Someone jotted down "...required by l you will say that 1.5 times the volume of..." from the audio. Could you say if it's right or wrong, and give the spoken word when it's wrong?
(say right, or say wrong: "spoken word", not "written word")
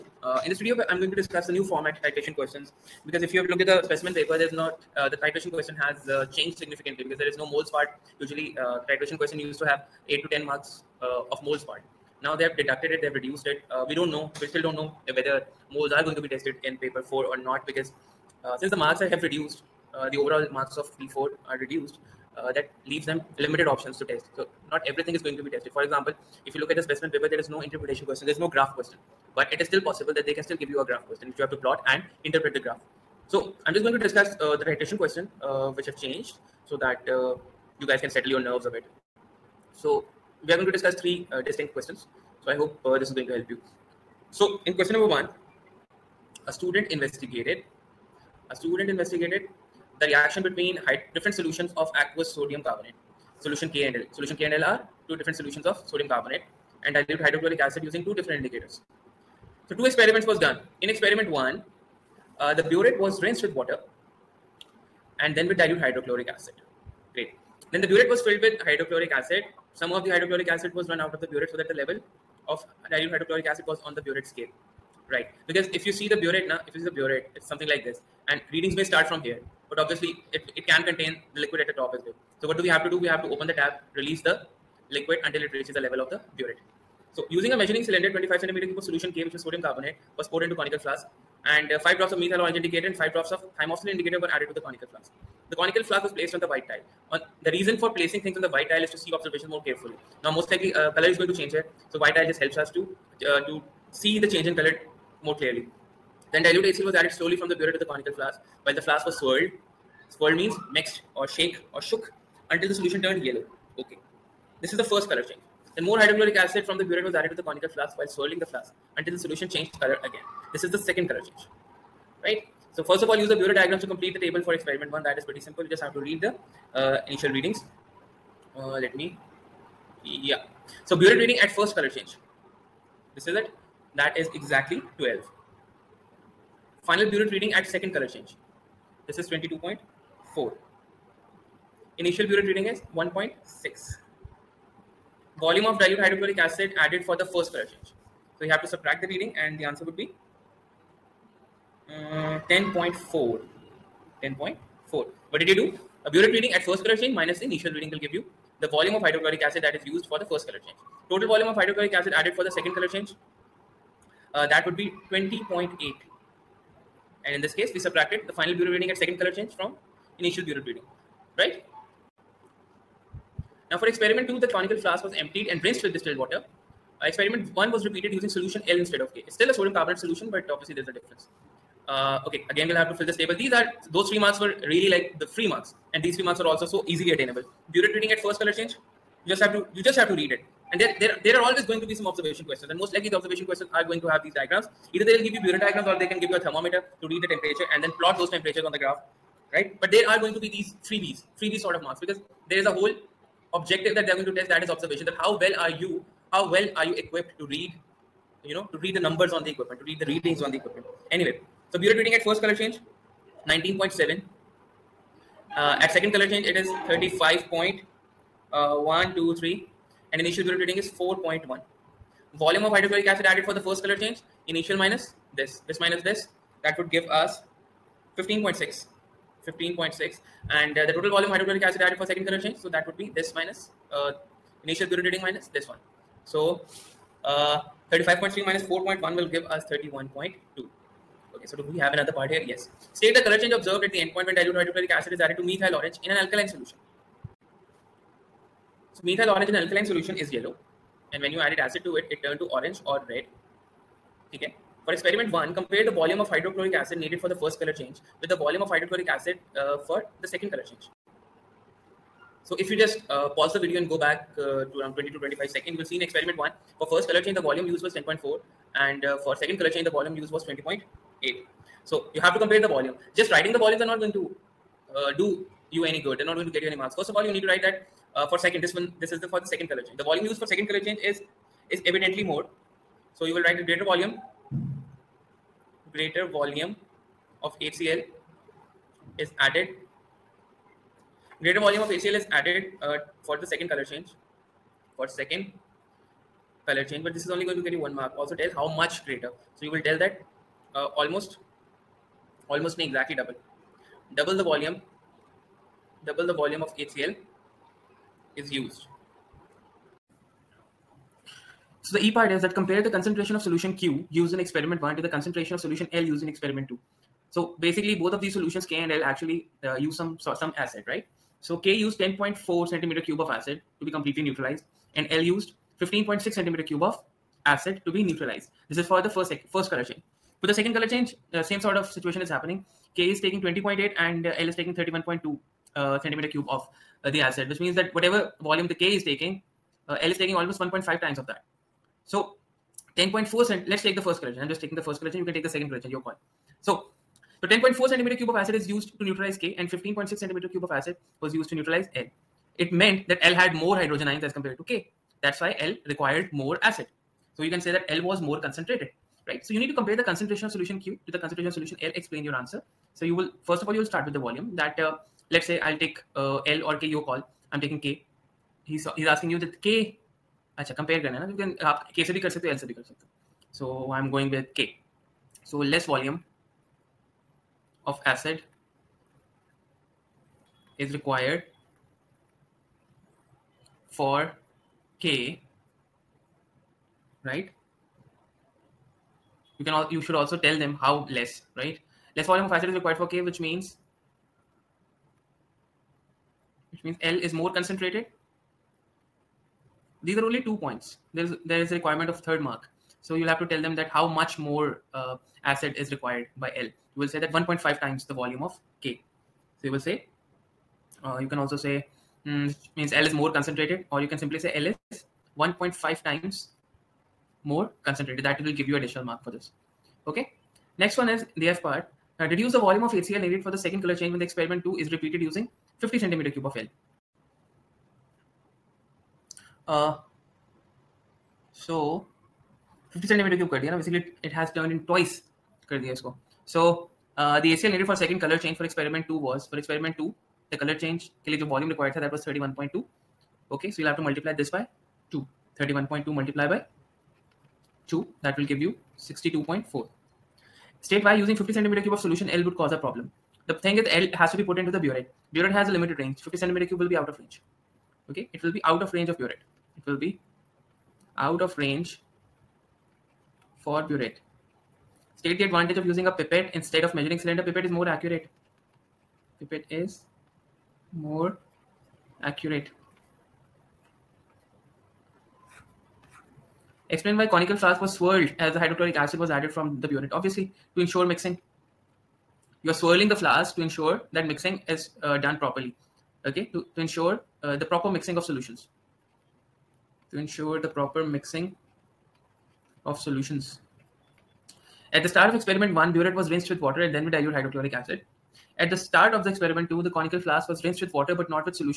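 right.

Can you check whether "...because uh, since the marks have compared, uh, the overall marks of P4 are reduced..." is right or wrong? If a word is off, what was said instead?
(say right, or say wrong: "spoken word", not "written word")
wrong: "reduced", not "compared".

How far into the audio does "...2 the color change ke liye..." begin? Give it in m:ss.
7:19.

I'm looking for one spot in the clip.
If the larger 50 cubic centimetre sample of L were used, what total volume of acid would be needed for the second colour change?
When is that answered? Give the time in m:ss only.
7:28.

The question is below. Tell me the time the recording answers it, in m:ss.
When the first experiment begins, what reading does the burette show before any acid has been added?
2:22.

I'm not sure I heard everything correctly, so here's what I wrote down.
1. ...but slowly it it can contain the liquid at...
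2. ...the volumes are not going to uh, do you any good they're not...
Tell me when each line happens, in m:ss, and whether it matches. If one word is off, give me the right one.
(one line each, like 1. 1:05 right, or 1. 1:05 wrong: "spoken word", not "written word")
1. 1:19 wrong: "obviously", not "slowly"
2. 4:33 right.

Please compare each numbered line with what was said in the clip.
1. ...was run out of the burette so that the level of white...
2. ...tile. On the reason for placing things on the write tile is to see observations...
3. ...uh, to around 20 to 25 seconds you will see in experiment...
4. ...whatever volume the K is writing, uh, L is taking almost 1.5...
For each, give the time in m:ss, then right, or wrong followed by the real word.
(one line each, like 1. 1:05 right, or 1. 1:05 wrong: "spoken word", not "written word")
1. 1:10 wrong: "dilute", not "white"
2. 1:36 wrong: "white", not "write"
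3. 4:24 right
4. 5:37 wrong: "taking", not "writing".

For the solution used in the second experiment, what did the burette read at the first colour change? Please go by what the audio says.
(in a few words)
19.7.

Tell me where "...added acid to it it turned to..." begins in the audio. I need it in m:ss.
4:11.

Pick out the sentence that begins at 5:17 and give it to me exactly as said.
So basically both of these solutions K and L actually uh, use some some acid, right?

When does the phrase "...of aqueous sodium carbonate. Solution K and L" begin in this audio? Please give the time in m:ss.
0:51.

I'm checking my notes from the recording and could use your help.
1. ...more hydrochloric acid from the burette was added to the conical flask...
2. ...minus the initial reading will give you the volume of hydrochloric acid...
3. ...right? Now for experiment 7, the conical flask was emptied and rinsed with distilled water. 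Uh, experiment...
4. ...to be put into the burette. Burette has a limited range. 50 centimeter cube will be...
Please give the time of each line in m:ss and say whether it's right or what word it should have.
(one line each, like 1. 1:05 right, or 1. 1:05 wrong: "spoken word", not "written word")
1. 1:55 right
2. 2:37 right
3. 2:51 wrong: "2", not "7"
4. 7:34 right.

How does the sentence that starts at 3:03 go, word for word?
These are, those three marks were really like the free marks.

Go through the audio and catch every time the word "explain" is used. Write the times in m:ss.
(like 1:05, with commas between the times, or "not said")
6:01, 7:56.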